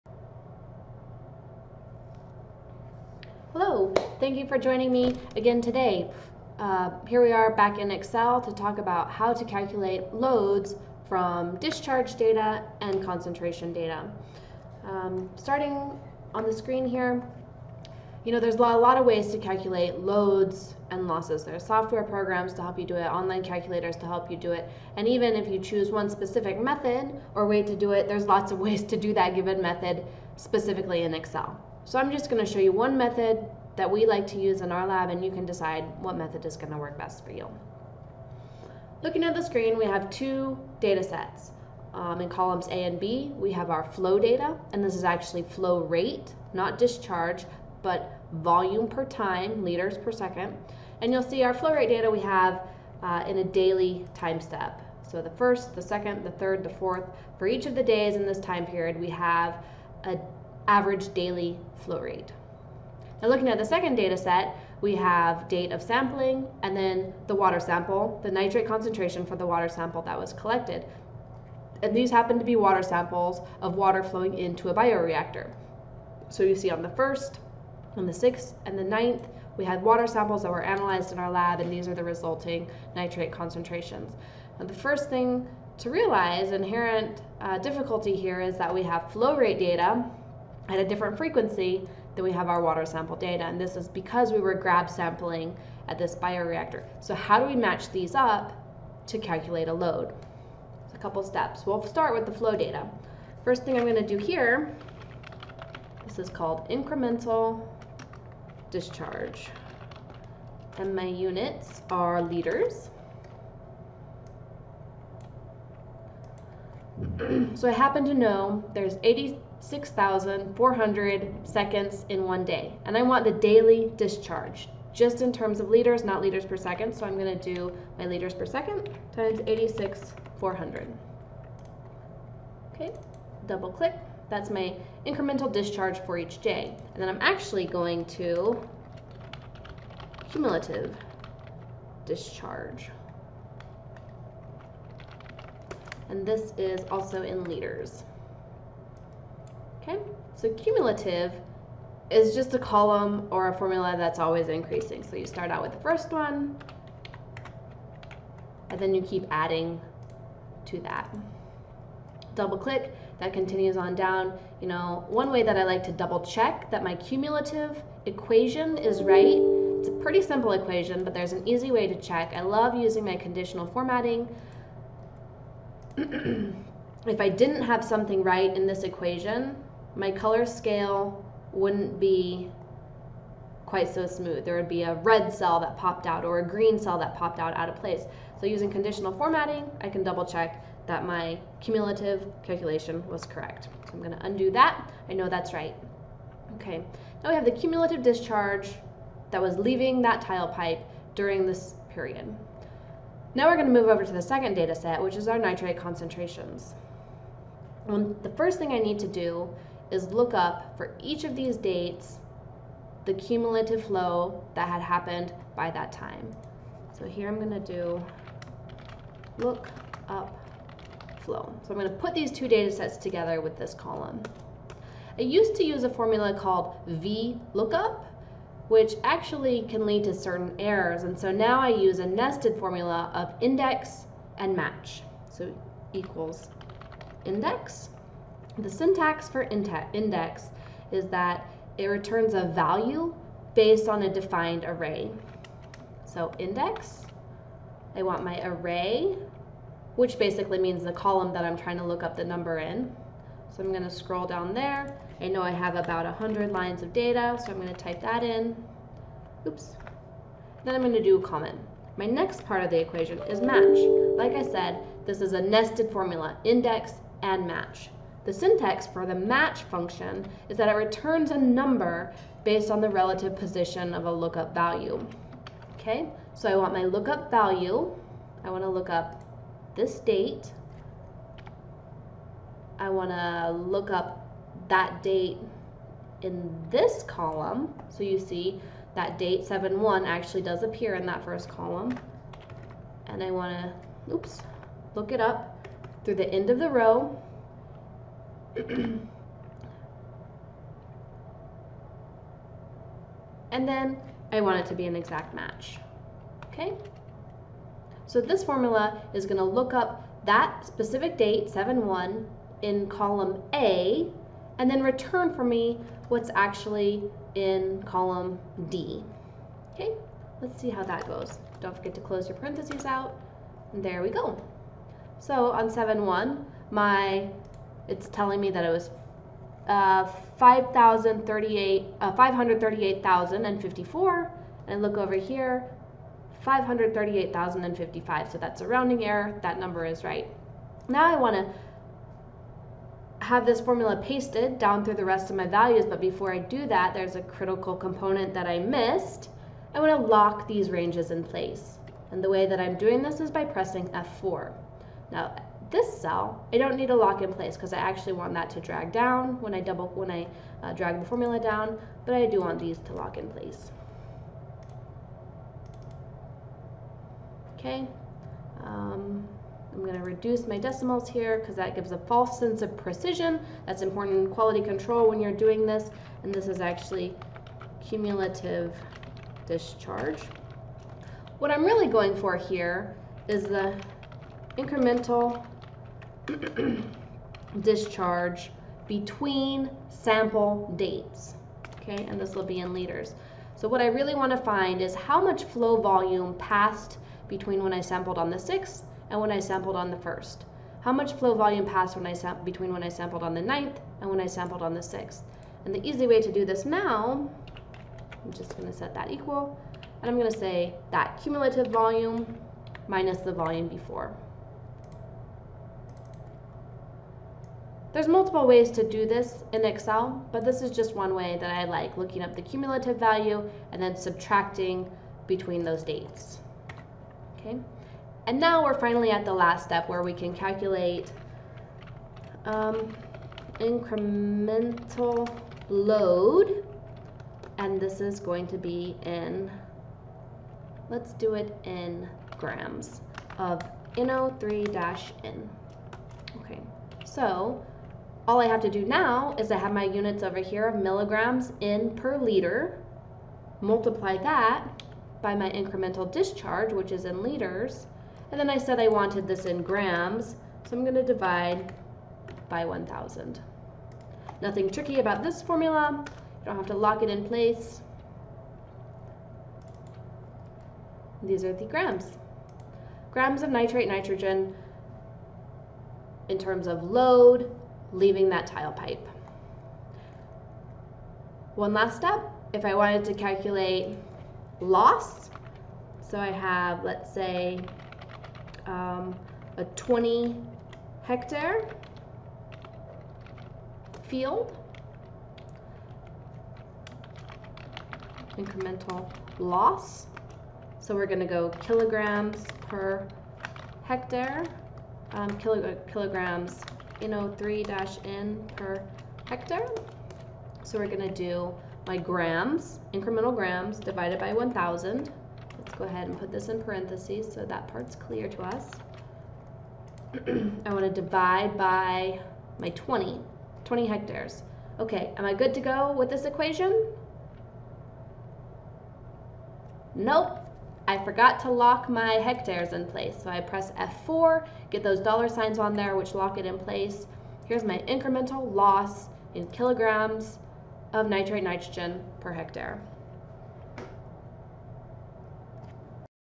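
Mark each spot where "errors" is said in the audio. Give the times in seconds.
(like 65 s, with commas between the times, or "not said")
230 s, 339 s.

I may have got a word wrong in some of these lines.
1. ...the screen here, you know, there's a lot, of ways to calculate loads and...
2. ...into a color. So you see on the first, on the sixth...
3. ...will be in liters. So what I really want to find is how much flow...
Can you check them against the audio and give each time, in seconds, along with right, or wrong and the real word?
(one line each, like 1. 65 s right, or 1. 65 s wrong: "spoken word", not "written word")
1. 16 s right
2. 74 s wrong: "bioreactor", not "color"
3. 392 s right.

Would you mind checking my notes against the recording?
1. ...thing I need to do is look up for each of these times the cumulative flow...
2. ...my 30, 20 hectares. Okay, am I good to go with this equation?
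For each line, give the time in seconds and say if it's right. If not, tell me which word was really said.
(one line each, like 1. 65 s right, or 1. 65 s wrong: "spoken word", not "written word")
1. 208 s wrong: "dates", not "times"
2. 522 s wrong: "20", not "30".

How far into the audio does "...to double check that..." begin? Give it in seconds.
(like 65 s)
165 s.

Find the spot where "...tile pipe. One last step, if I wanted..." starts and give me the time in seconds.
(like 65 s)
478 s.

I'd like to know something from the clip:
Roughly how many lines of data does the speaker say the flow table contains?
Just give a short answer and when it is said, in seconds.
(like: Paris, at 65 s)
about 100, at 255 s.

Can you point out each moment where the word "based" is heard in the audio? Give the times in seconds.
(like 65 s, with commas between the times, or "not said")
243 s, 272 s.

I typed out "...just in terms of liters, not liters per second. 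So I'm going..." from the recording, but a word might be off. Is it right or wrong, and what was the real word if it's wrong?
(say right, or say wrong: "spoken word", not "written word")
right.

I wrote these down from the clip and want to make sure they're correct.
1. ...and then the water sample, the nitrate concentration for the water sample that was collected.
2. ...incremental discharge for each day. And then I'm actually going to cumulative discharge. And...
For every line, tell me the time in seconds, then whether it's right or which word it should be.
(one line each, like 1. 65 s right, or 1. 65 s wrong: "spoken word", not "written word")
1. 66 s right
2. 135 s right.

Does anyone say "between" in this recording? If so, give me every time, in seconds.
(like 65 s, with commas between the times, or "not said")
388 s, 397 s, 402 s, 425 s.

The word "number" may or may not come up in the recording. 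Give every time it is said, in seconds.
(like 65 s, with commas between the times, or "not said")
252 s, 271 s, 339 s.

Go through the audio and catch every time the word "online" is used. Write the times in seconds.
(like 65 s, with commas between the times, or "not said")
23 s.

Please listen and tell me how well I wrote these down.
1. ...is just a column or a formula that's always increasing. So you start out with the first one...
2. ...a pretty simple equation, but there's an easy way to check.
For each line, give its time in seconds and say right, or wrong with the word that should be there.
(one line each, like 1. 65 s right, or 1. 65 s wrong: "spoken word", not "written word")
1. 152 s right
2. 169 s right.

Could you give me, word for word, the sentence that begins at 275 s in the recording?
Okay, so I want my lookup value.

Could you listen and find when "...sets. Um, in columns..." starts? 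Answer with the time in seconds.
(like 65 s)
41 s.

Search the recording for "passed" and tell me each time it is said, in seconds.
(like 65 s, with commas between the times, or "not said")
396 s, 401 s.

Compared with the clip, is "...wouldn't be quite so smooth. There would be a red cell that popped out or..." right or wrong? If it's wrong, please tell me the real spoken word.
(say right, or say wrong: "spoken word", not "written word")
right.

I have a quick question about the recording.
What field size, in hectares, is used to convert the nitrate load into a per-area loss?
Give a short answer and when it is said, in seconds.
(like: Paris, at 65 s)
20 hectares, at 489 s.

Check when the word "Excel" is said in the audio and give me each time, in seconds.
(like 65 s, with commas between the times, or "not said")
7 s, 31 s, 419 s.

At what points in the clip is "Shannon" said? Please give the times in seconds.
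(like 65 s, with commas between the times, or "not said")
not said.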